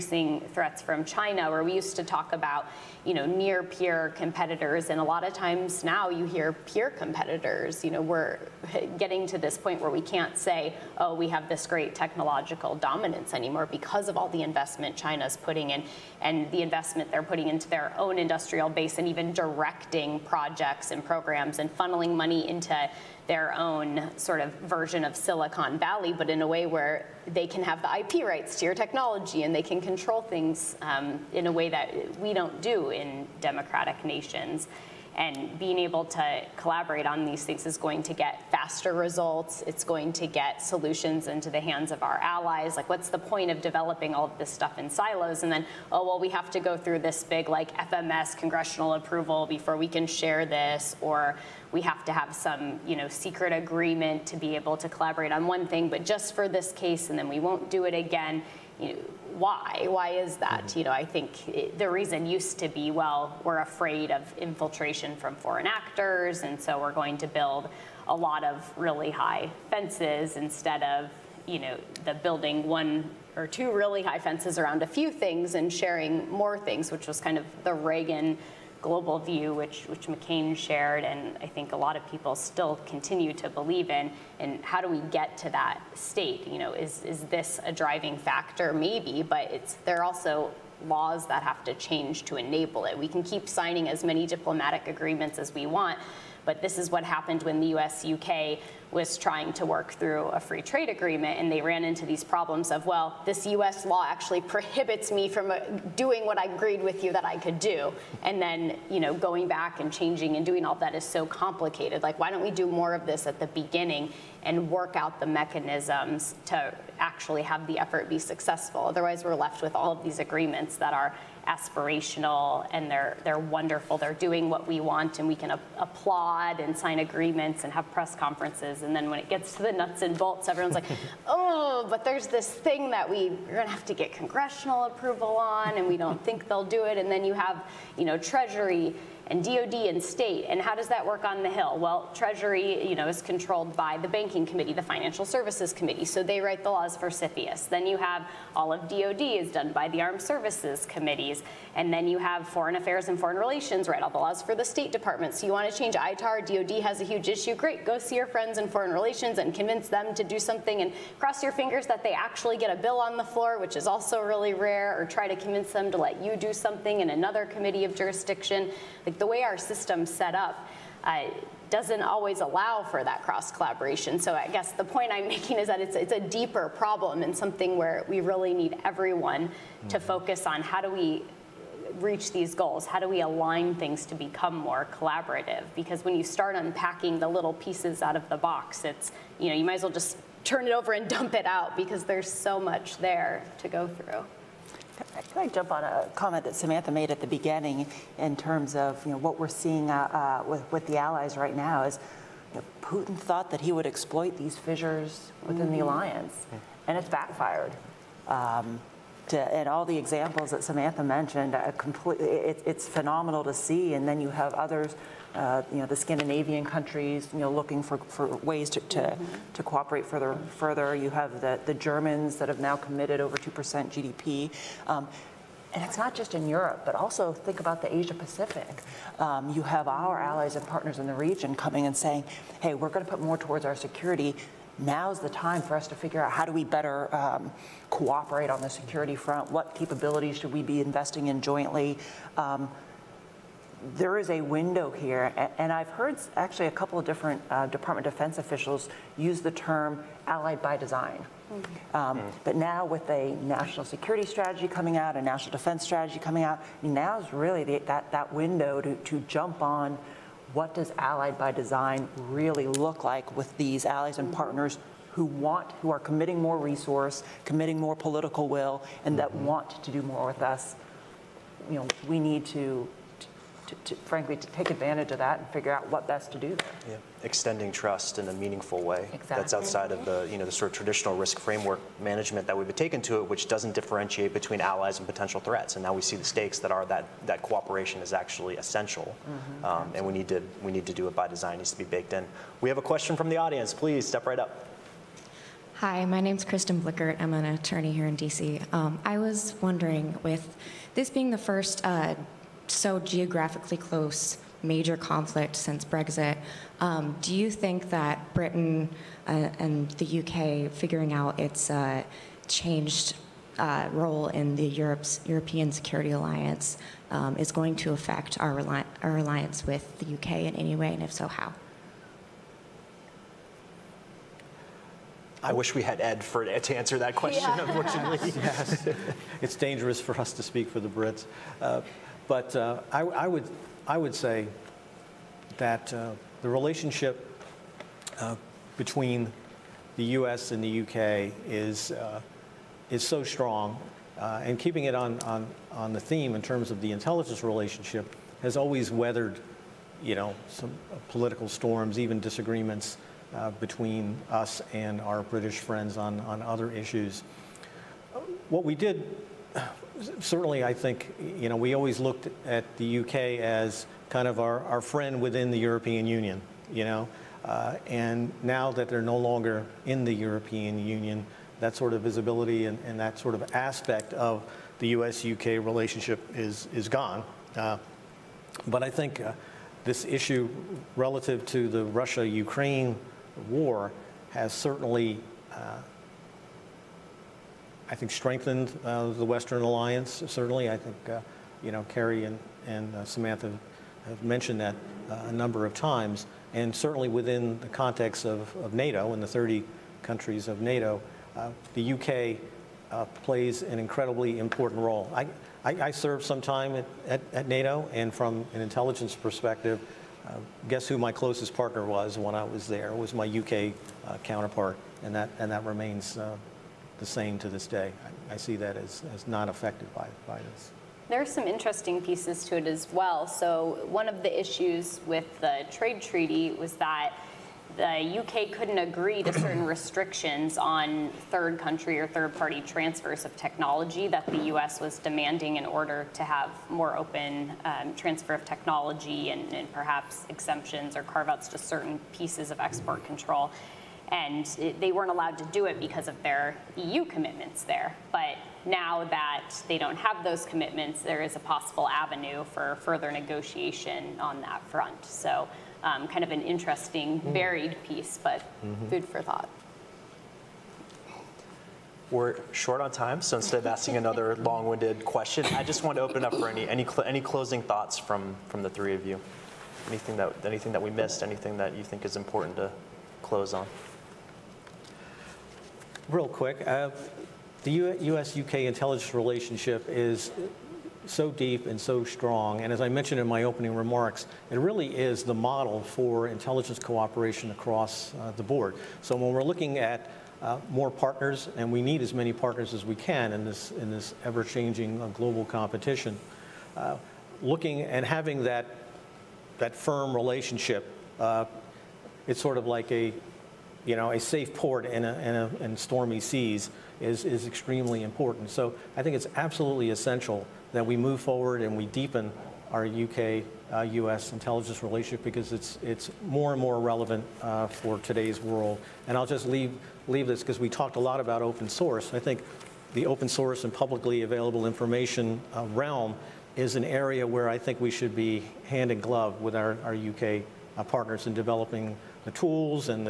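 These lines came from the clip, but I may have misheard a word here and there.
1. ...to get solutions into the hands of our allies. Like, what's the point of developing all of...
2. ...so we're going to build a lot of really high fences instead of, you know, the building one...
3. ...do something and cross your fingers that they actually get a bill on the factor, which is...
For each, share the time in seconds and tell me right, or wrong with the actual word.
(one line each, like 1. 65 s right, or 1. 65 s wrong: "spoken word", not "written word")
1. 40 s right
2. 66 s right
3. 160 s wrong: "floor", not "factor".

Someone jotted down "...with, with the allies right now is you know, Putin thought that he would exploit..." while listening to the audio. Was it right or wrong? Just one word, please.
right.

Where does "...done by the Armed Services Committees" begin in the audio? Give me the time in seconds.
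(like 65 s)
149 s.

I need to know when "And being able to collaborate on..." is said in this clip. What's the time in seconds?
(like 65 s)
35 s.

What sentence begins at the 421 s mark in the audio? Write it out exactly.
There are some interesting pieces to it as well.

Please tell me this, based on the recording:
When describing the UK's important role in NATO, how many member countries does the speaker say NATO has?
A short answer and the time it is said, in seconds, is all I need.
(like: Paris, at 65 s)
30, at 399 s.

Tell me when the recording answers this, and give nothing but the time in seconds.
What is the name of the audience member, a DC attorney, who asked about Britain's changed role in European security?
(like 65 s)
296 s.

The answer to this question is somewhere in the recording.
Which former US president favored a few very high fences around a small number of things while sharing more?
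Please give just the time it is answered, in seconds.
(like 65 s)
77 s.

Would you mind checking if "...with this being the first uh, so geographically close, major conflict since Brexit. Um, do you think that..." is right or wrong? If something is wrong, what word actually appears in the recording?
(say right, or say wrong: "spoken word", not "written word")
right.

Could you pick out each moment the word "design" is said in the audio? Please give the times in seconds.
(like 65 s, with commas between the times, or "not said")
250 s, 261 s, 291 s.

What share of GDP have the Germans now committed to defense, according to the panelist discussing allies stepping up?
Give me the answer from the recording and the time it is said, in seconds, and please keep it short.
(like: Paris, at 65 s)
over 2%, at 223 s.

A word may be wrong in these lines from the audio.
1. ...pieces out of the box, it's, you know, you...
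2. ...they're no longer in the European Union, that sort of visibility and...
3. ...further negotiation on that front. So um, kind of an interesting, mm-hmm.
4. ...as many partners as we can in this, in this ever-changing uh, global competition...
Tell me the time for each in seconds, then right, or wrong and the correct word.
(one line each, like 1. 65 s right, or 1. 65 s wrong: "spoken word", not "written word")
1. 187 s right
2. 368 s right
3. 452 s right
4. 492 s right.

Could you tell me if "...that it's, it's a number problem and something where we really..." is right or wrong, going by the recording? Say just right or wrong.
wrong.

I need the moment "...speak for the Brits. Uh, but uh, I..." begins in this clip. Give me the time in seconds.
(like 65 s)
330 s.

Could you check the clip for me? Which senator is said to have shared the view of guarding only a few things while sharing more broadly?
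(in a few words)
McCain.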